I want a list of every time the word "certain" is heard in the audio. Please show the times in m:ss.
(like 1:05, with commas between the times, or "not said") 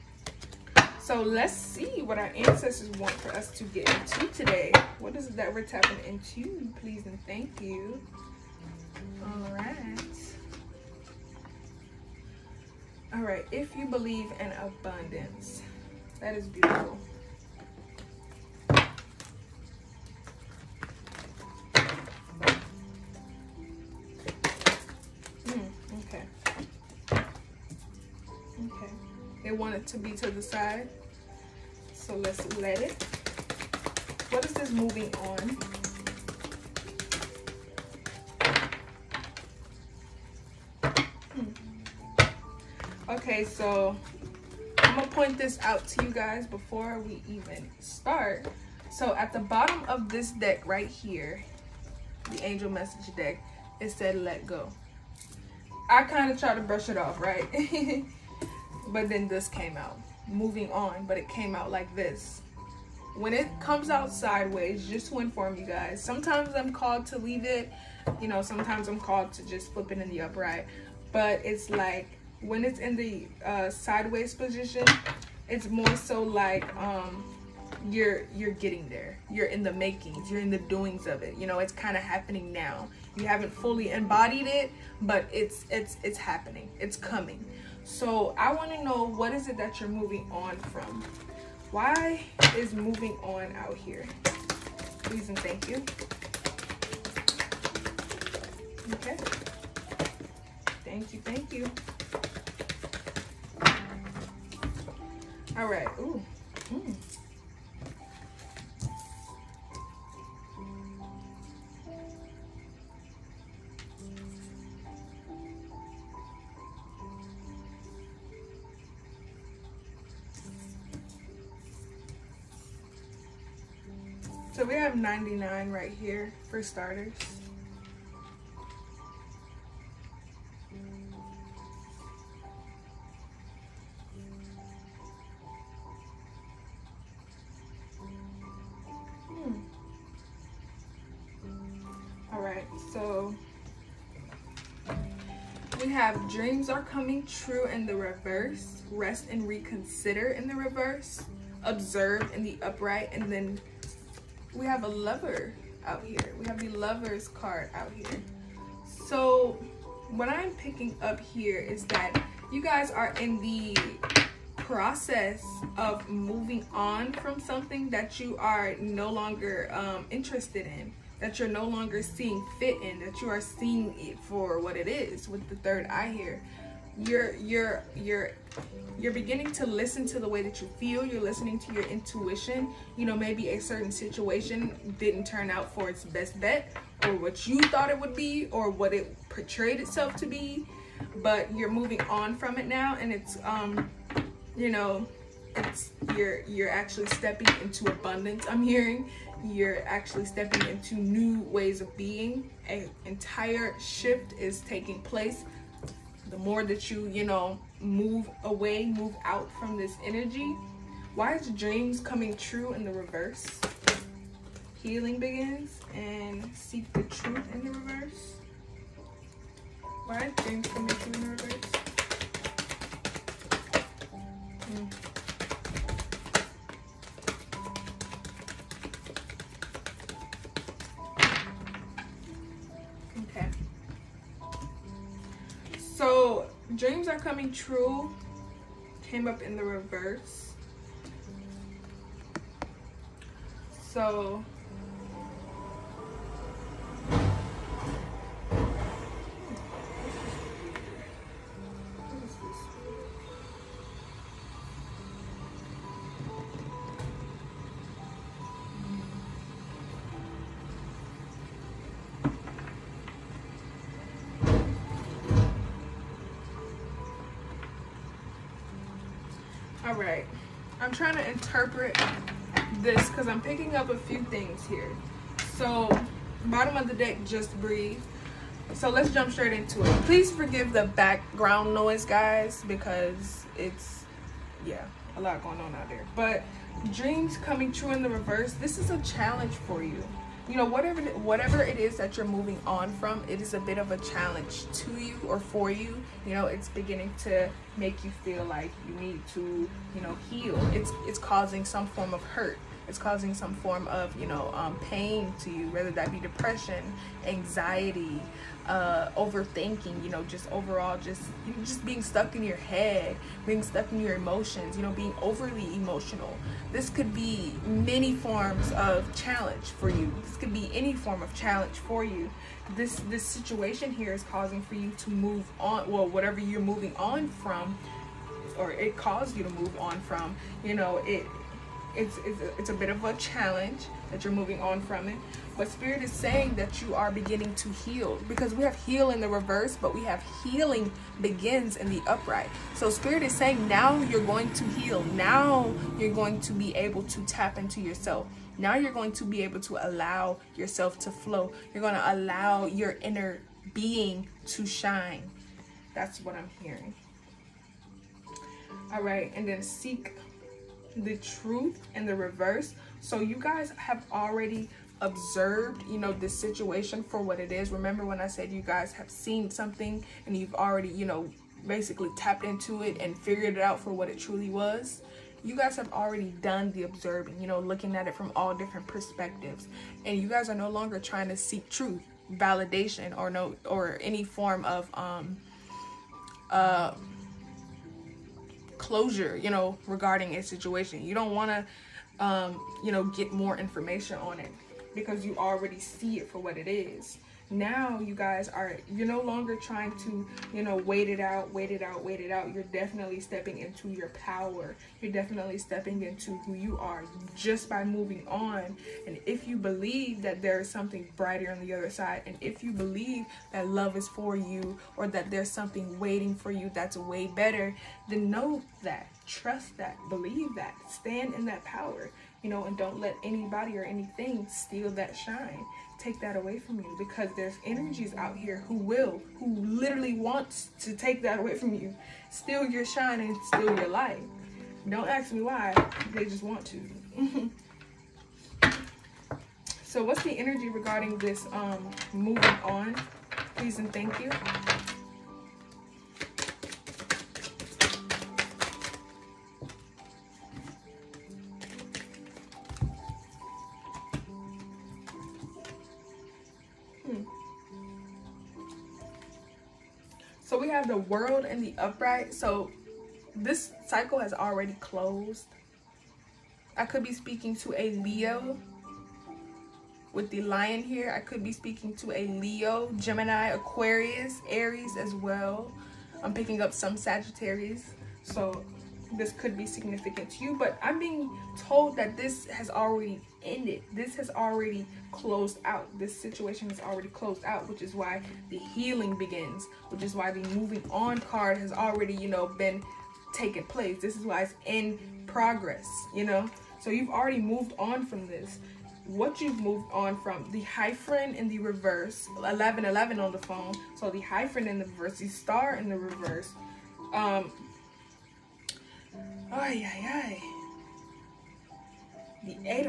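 3:03.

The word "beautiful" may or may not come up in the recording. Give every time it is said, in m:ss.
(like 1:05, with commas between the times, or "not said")
0:16.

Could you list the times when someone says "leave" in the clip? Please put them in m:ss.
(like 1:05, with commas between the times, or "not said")
1:07.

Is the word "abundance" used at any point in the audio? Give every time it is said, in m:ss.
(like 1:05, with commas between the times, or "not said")
0:14, 3:17.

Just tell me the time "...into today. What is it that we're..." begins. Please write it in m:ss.
0:03.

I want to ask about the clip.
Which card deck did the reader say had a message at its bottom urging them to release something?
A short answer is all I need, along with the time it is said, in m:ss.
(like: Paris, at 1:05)
angel message deck, at 0:52.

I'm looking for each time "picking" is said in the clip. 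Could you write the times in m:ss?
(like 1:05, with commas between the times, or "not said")
2:40, 4:33, 7:56.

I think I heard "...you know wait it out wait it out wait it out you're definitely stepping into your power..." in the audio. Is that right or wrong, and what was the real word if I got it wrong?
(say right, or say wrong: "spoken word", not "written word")
right.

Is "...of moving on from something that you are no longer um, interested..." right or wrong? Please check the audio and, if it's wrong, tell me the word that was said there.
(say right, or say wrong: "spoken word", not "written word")
right.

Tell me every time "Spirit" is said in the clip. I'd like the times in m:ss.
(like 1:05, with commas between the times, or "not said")
5:35, 5:42.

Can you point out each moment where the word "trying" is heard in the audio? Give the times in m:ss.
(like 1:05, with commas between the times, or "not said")
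6:20, 6:39.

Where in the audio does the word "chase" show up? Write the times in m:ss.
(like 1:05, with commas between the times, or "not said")
not said.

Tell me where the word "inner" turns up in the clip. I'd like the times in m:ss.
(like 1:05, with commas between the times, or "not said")
5:53.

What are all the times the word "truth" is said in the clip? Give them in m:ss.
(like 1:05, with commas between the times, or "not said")
3:37, 6:01, 6:21.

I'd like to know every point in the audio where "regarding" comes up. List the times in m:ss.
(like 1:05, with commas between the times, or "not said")
6:29, 7:20.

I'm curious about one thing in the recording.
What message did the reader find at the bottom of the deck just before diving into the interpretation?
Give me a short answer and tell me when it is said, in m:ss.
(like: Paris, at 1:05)
just breathe, at 4:37.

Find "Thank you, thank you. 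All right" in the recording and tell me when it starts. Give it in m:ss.
1:40.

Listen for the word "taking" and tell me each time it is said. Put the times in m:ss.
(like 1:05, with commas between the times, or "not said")
3:24.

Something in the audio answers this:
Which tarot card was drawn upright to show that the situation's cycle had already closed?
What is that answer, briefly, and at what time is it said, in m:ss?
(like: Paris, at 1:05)
the world, at 7:40.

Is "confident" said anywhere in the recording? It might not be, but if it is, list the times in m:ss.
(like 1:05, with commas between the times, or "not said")
not said.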